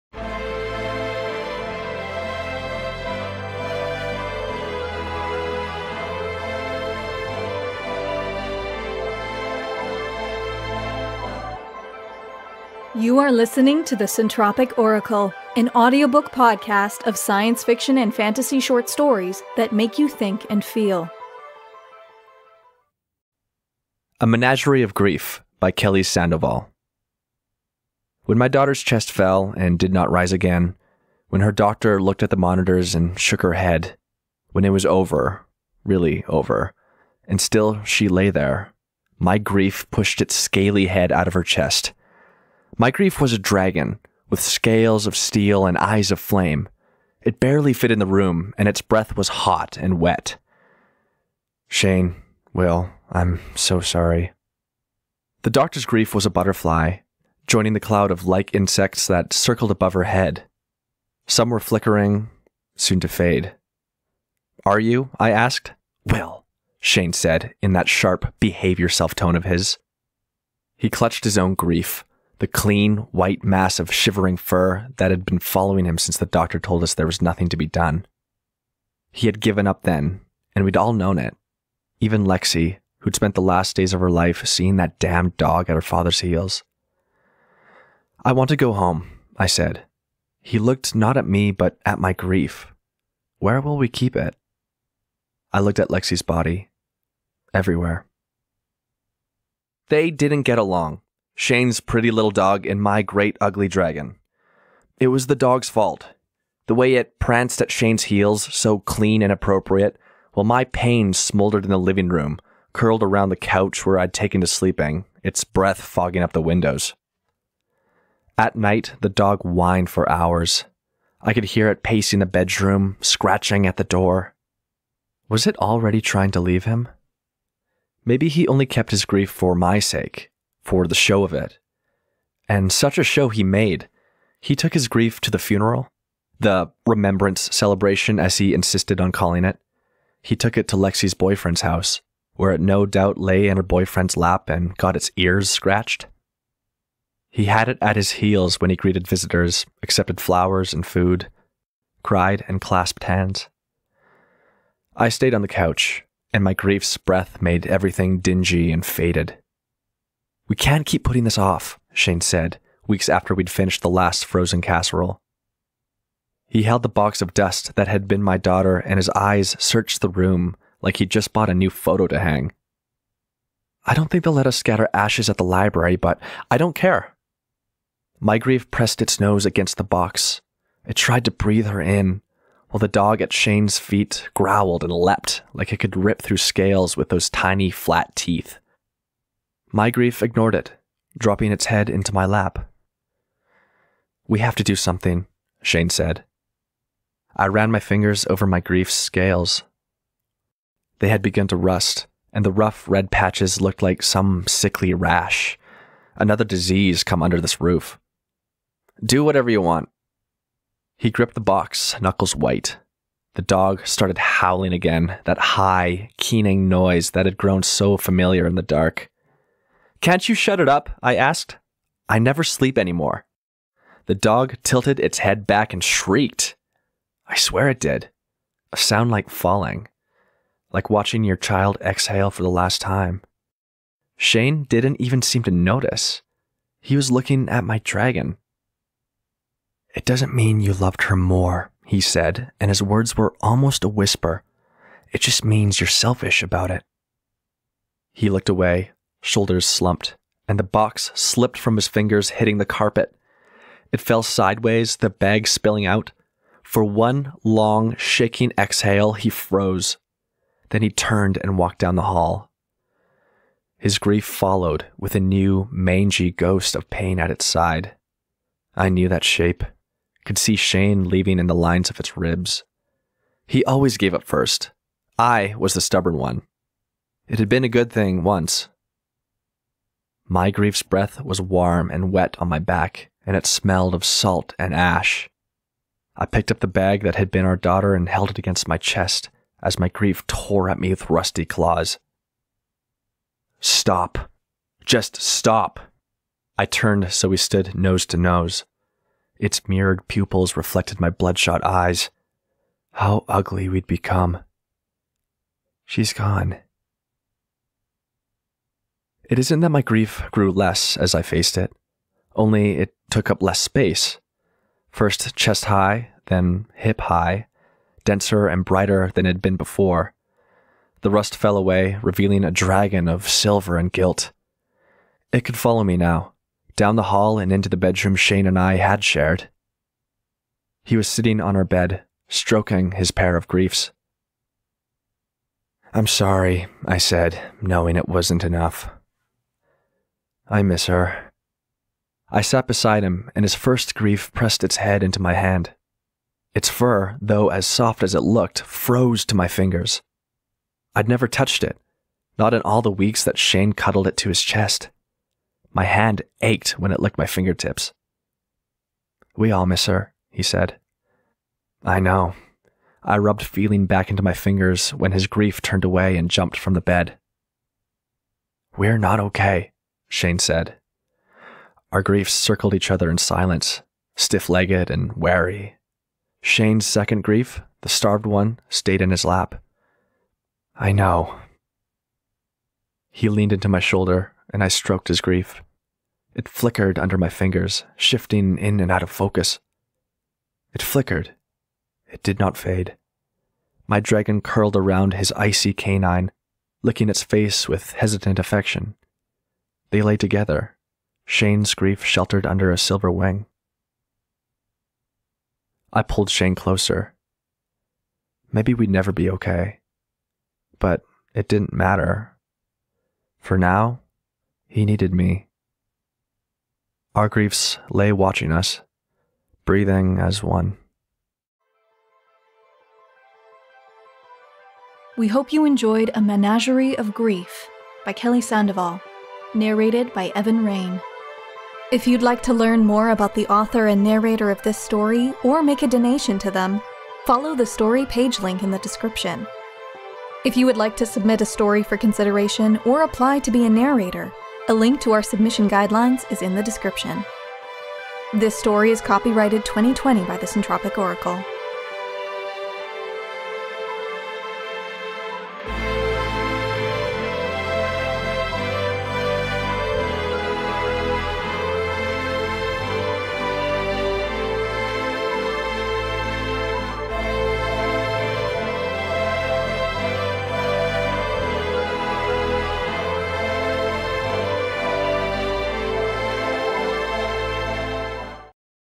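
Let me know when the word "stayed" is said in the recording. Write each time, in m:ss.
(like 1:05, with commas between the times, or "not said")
2:35, 6:18.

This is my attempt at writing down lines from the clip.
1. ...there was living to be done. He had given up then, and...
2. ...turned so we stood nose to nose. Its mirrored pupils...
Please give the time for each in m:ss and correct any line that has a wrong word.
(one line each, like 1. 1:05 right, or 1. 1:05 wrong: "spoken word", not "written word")
1. 1:16 wrong: "nothing", not "living"
2. 4:56 right.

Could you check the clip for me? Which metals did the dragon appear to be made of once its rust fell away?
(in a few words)
Silver and gilt.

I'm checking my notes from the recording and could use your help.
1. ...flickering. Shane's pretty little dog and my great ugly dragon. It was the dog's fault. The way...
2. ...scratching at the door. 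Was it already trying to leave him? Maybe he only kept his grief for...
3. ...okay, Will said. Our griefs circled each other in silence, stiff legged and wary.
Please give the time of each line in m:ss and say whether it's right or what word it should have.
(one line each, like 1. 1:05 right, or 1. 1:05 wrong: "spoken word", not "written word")
1. 1:40 wrong: "along", not "flickering"
2. 2:03 right
3. 6:09 wrong: "Shane", not "Will".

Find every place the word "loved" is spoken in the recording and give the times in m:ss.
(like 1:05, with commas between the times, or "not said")
4:00.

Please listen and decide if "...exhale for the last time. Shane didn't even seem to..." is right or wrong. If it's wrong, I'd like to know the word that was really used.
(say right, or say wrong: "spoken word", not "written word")
right.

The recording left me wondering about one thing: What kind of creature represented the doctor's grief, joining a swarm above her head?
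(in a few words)
Butterfly.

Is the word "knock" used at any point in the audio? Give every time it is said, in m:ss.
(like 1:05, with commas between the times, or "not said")
not said.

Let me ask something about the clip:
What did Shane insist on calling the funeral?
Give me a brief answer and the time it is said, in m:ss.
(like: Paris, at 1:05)
The remembrance celebration, at 2:16.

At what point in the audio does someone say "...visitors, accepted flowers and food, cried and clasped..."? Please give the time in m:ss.
2:29.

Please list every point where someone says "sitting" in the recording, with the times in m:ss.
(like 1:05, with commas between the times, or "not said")
5:31.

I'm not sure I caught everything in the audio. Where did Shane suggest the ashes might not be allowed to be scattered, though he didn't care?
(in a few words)
The library.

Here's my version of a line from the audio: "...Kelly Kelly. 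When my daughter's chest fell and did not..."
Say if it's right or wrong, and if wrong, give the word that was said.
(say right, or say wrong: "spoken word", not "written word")
wrong: "Sandoval", not "Kelly".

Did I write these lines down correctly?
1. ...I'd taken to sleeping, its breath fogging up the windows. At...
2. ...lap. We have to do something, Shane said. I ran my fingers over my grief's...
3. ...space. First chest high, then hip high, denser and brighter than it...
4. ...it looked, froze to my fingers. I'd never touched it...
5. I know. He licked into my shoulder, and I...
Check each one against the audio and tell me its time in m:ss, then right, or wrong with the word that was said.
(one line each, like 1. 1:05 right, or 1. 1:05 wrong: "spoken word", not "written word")
1. 1:53 right
2. 3:12 right
3. 5:13 right
4. 5:48 right
5. 6:20 wrong: "leaned", not "licked".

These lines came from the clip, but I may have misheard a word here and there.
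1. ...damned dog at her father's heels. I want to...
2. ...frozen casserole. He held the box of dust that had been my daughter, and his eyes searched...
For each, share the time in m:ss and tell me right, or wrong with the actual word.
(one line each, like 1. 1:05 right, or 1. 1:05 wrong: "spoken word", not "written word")
1. 1:24 right
2. 2:44 right.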